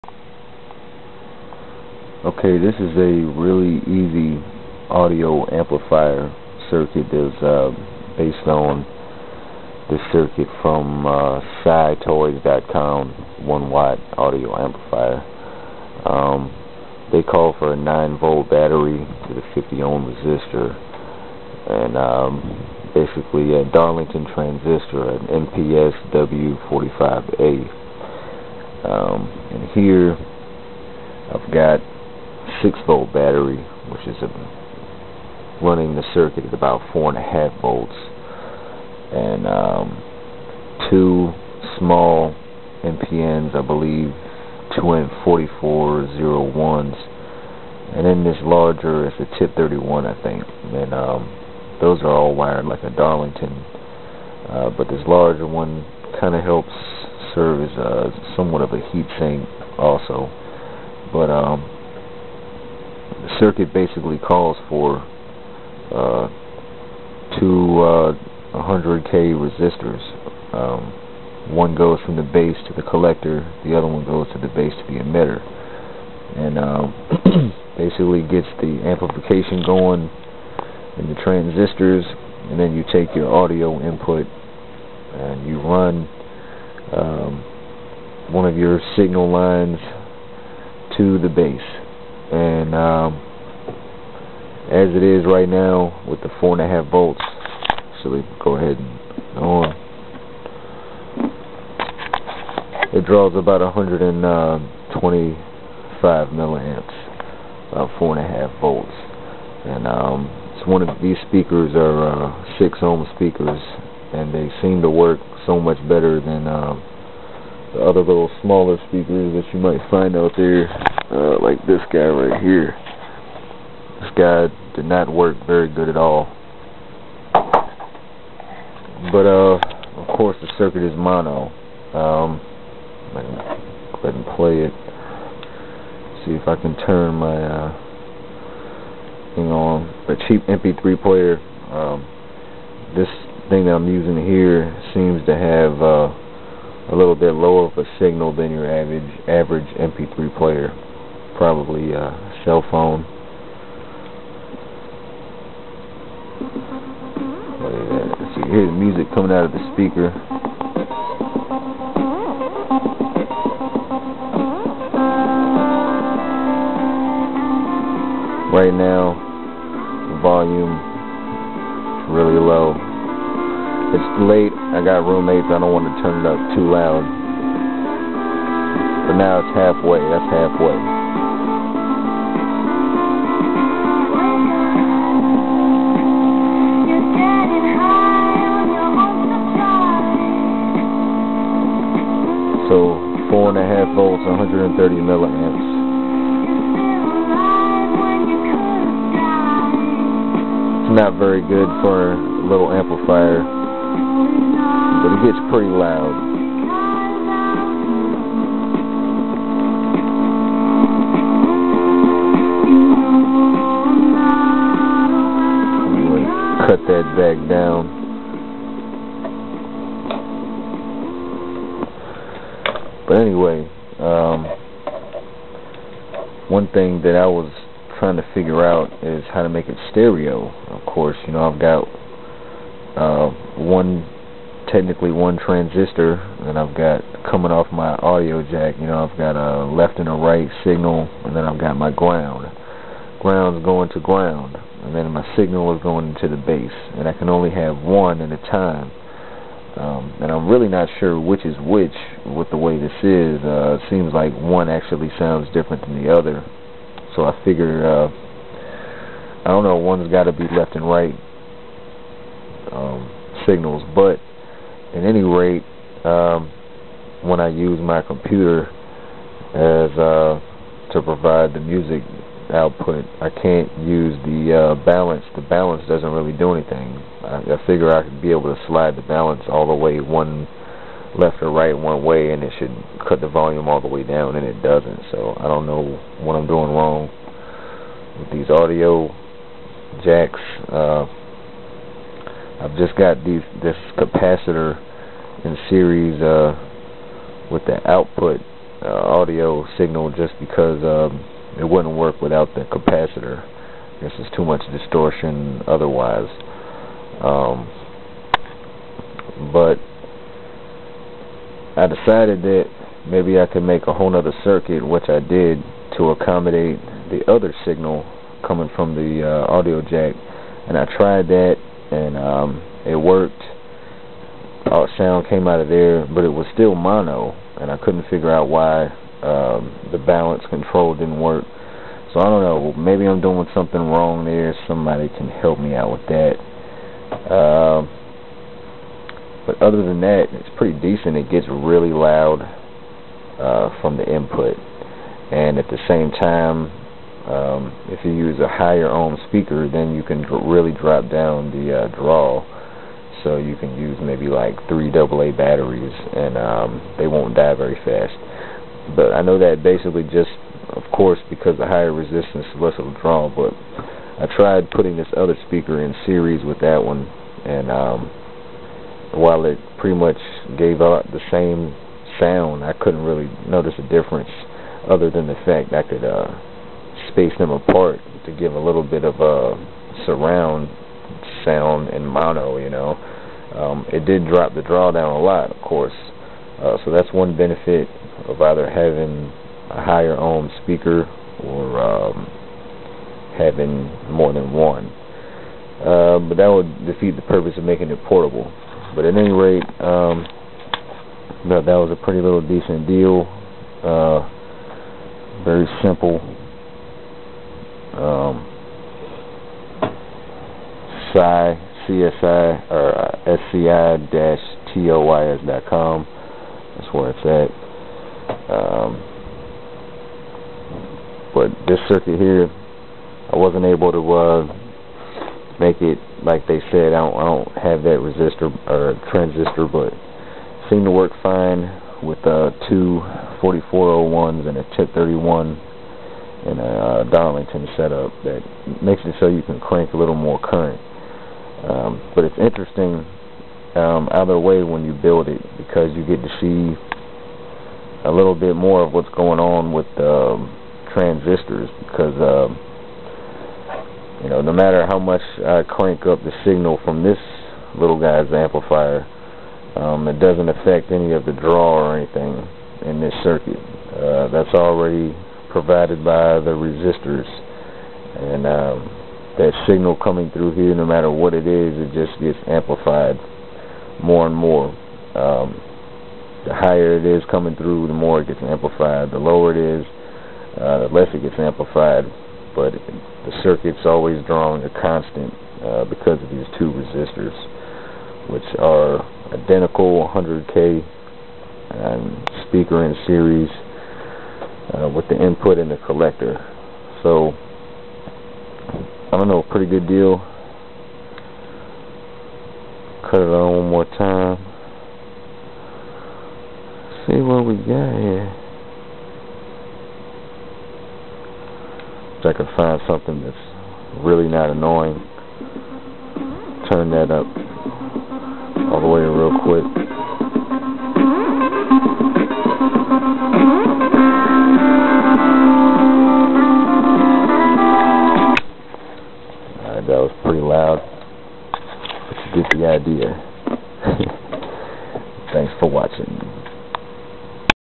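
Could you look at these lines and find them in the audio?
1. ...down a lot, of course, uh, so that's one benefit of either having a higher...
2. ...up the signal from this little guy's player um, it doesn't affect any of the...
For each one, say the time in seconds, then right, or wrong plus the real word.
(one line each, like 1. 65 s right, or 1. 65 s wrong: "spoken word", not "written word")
1. 384 s right
2. 456 s wrong: "amplifier", not "player".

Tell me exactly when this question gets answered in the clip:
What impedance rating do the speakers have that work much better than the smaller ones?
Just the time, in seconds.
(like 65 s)
112 s.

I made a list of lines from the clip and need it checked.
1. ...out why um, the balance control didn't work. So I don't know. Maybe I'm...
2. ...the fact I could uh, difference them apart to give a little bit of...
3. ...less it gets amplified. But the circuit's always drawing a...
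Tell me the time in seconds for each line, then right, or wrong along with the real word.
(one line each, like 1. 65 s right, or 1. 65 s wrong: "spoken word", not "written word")
1. 328 s right
2. 375 s wrong: "space", not "difference"
3. 480 s right.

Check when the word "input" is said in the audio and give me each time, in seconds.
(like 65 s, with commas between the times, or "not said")
83 s, 344 s, 495 s.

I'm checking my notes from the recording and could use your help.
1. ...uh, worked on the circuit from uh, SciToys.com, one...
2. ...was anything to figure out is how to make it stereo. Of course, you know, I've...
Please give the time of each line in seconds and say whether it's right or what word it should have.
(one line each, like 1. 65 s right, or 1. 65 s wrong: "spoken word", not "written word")
1. 7 s wrong: "based", not "worked"
2. 227 s wrong: "trying", not "anything".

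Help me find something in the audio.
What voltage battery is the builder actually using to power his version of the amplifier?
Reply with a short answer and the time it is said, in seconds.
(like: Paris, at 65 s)
6 volt, at 32 s.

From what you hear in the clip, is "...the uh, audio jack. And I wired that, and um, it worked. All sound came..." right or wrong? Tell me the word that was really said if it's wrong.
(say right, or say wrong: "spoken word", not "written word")
wrong: "tried", not "wired".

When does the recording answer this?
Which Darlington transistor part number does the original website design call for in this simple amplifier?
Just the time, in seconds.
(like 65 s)
25 s.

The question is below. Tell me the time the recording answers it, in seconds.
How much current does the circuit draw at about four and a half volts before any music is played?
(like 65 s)
103 s.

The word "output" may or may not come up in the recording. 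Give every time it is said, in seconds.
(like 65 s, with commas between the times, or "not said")
272 s, 297 s.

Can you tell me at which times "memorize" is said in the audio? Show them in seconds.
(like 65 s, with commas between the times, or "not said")
not said.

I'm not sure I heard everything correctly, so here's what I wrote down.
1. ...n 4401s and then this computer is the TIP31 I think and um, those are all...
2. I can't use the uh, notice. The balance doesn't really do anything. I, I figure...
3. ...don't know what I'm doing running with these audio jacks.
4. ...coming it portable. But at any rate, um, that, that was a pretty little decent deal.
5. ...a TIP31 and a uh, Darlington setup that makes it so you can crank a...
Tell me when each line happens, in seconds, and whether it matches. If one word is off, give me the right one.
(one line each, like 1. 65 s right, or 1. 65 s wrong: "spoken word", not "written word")
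1. 44 s wrong: "larger", not "computer"
2. 273 s wrong: "balance", not "notice"
3. 285 s wrong: "wrong", not "running"
4. 397 s wrong: "making", not "coming"
5. 434 s right.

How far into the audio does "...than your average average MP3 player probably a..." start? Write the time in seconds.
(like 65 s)
148 s.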